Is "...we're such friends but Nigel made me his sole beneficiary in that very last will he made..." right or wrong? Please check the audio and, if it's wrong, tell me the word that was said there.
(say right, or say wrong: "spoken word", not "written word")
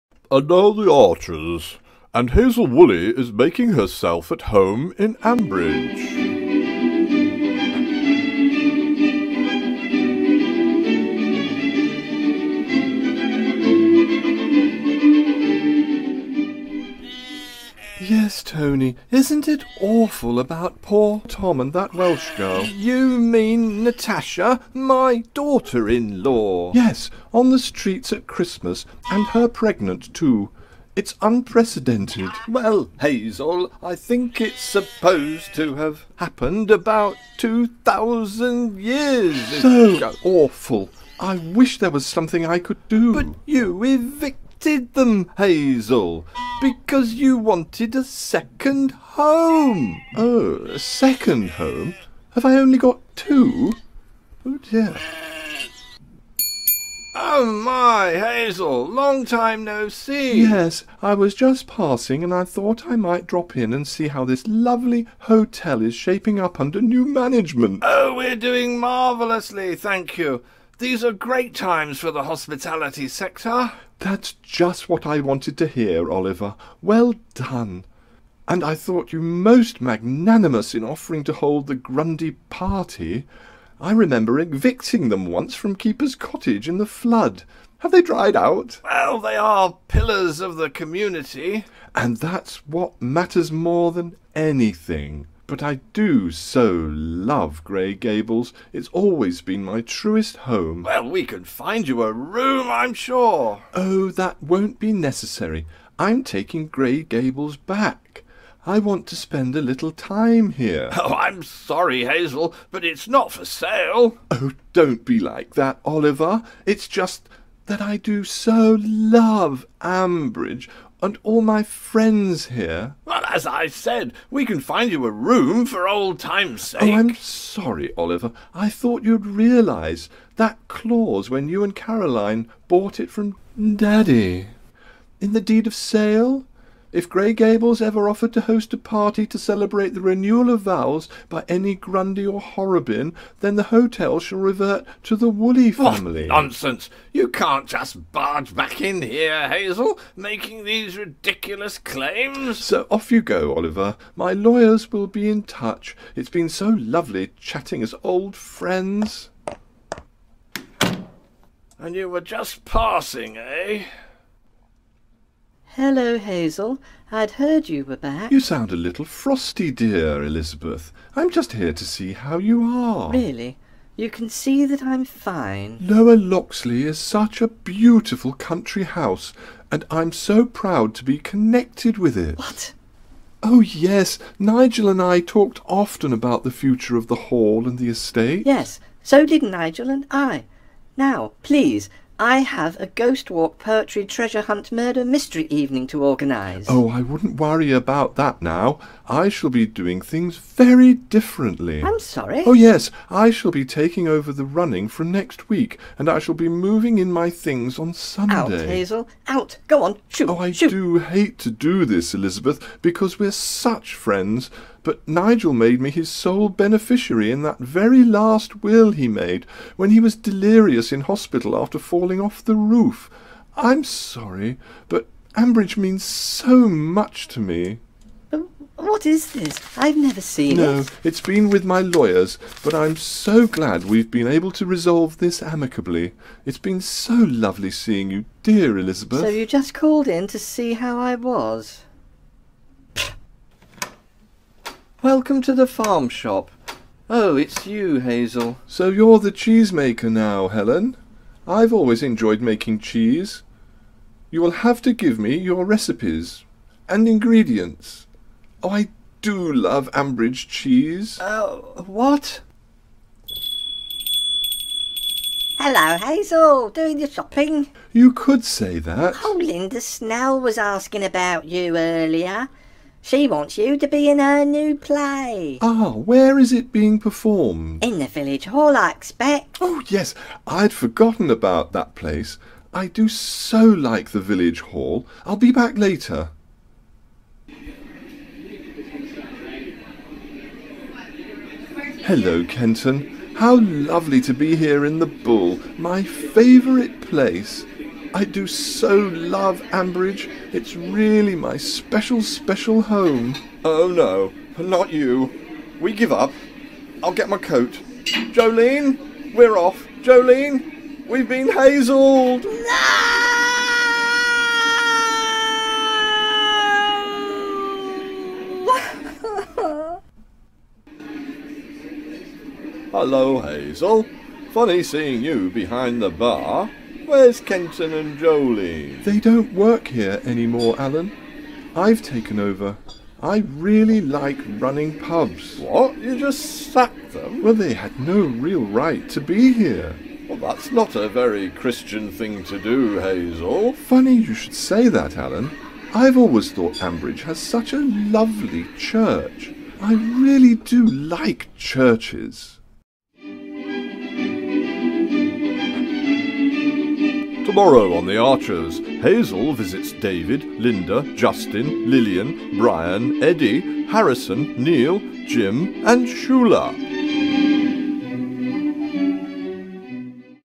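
right.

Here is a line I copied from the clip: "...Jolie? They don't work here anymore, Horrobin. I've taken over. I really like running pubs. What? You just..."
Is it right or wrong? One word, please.
wrong.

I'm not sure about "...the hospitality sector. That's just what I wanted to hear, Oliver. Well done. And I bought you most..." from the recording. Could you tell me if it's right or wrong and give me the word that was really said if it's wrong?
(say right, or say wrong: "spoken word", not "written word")
wrong: "thought", not "bought".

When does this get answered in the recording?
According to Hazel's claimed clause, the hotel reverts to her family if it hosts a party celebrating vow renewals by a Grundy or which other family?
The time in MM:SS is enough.
02:22.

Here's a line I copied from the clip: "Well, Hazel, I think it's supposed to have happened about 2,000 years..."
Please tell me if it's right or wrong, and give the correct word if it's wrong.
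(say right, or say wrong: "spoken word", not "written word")
right.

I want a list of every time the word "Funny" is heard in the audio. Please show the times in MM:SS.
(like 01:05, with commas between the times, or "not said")
05:24, 05:43.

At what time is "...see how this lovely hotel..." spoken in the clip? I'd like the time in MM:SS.
01:03.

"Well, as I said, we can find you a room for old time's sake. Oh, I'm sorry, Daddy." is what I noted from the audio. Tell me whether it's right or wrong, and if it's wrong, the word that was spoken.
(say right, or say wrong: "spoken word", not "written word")
wrong: "Oliver", not "Daddy".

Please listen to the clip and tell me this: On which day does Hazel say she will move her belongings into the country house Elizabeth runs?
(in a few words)
Sunday.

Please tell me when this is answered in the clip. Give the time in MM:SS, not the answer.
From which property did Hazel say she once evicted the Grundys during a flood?
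01:25.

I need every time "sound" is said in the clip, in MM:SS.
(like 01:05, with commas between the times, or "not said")
02:48.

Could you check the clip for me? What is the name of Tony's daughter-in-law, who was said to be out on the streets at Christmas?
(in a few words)
Natasha.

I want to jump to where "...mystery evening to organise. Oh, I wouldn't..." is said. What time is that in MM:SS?
03:15.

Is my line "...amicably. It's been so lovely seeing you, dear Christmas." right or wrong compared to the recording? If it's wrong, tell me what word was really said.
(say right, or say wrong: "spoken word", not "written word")
wrong: "Elizabeth", not "Christmas".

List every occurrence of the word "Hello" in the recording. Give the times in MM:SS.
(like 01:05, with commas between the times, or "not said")
02:45, 04:25, 04:52, 05:22.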